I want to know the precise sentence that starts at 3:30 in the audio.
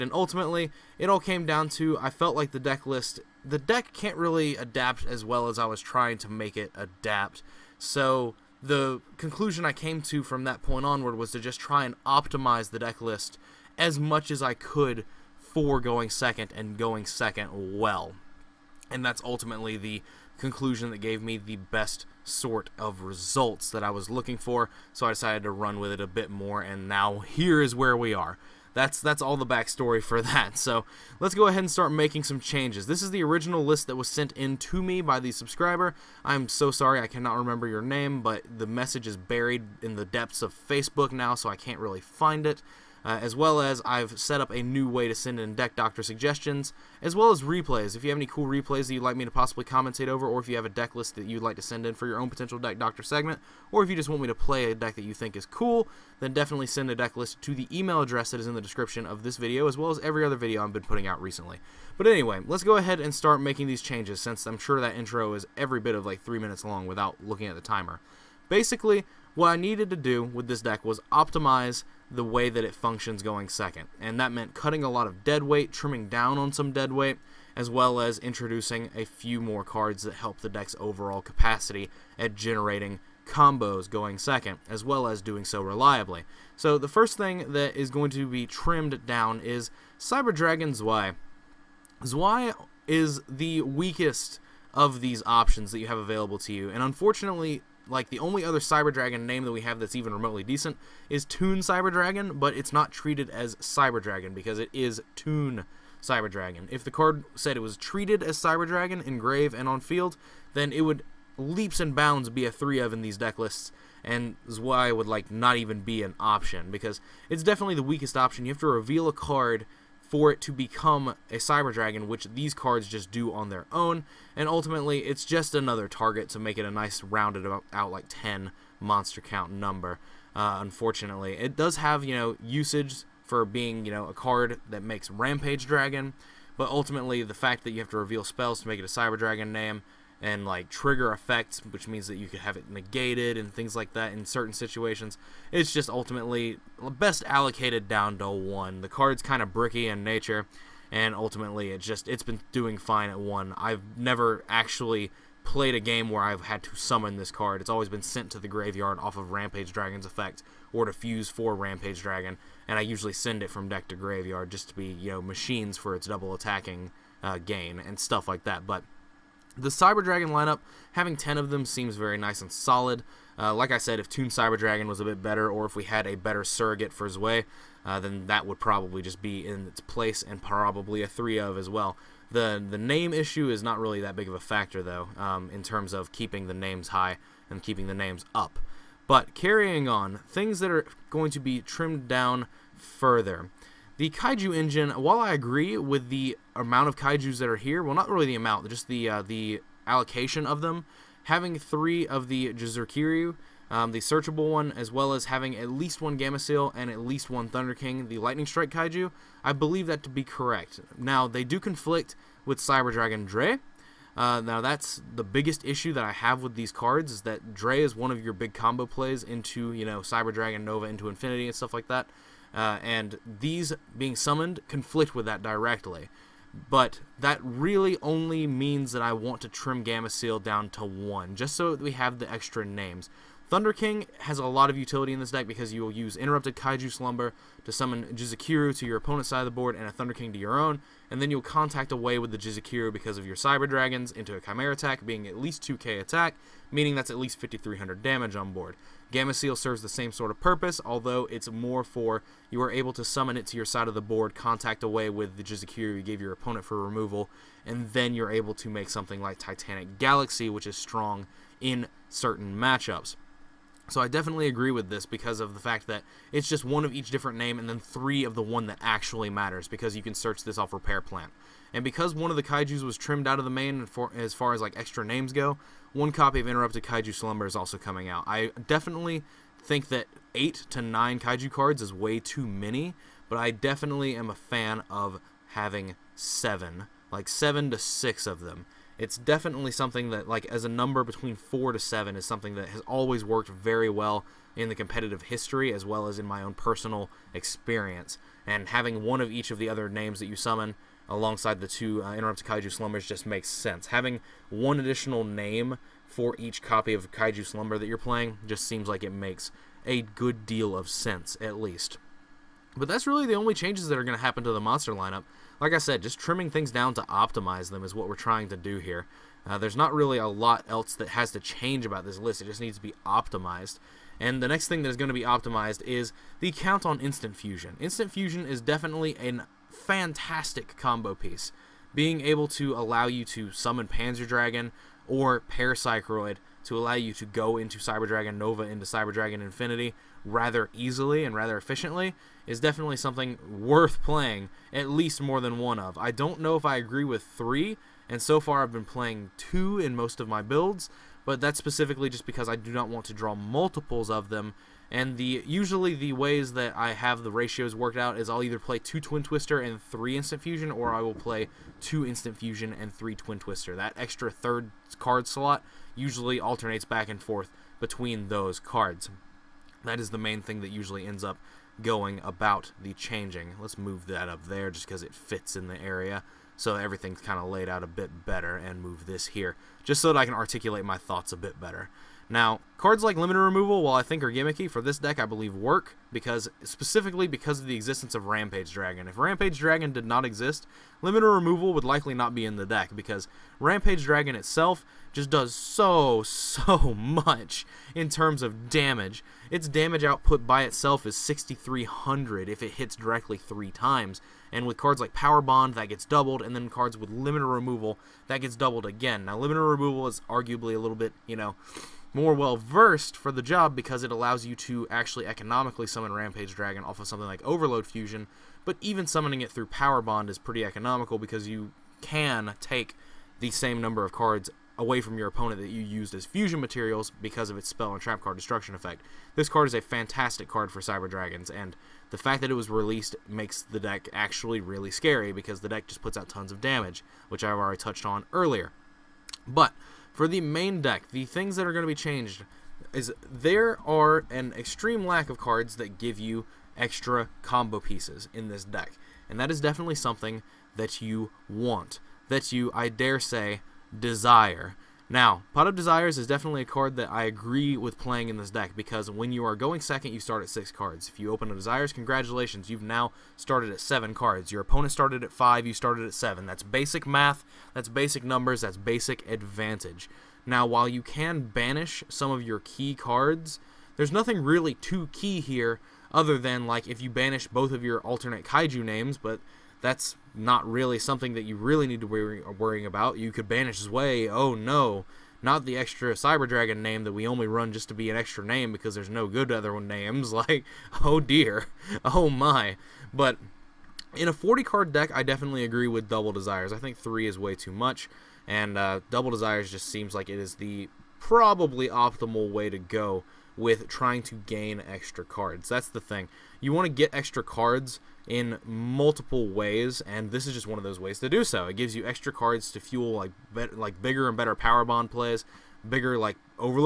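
Now, they do conflict with Cyber Dragon Drei.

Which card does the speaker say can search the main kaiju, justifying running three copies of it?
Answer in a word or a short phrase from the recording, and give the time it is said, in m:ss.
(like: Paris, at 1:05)
Repair Plant, at 4:30.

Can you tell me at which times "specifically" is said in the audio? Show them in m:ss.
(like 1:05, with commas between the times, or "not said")
5:51, 6:26.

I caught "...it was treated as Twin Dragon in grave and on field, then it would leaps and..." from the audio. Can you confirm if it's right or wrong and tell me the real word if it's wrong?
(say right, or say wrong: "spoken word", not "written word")
wrong: "Cyber", not "Twin".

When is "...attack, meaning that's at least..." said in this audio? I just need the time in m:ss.
4:06.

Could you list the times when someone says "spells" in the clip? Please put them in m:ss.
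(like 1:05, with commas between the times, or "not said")
2:18, 7:07.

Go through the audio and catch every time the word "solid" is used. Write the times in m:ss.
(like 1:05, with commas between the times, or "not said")
2:52.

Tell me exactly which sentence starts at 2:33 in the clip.
I've never actually played a game where I've had to summon this card.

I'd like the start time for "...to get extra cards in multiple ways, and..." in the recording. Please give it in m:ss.
8:26.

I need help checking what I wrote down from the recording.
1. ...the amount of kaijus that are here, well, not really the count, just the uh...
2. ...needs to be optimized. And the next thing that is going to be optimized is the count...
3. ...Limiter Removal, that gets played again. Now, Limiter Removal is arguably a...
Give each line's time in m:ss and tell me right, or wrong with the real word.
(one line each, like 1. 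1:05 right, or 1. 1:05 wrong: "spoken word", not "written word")
1. 3:16 wrong: "amount", not "count"
2. 5:22 right
3. 6:47 wrong: "doubled", not "played".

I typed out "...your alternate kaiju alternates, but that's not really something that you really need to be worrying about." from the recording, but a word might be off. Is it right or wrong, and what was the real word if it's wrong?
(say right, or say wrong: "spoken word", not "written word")
wrong: "names", not "alternates".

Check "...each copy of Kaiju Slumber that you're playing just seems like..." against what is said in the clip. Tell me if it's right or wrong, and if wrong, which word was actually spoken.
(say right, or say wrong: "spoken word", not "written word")
right.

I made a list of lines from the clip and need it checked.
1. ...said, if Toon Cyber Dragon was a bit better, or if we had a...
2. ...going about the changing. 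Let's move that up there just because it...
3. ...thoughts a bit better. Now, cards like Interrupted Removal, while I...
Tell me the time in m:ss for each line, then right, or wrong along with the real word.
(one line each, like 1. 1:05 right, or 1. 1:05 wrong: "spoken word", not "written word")
1. 2:53 right
2. 6:11 right
3. 6:20 wrong: "Limiter", not "Interrupted".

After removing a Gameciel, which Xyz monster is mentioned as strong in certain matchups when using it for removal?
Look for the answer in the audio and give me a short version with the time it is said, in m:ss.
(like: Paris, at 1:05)
Titanic Galaxy, at 4:19.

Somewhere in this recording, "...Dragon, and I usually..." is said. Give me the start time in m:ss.
2:42.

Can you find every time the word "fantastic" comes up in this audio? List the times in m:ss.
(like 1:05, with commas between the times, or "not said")
5:29, 7:09.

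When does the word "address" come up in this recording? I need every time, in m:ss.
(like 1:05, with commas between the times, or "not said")
0:58.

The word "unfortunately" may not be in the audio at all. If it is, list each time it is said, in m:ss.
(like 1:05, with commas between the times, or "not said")
1:36, 2:10.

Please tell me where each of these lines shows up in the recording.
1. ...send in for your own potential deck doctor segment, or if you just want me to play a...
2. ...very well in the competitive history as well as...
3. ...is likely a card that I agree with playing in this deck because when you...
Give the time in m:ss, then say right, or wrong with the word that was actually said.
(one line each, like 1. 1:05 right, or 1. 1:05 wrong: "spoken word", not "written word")
1. 0:51 right
2. 4:53 right
3. 7:36 wrong: "definitely", not "likely".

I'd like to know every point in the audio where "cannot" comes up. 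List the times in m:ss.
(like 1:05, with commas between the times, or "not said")
0:37.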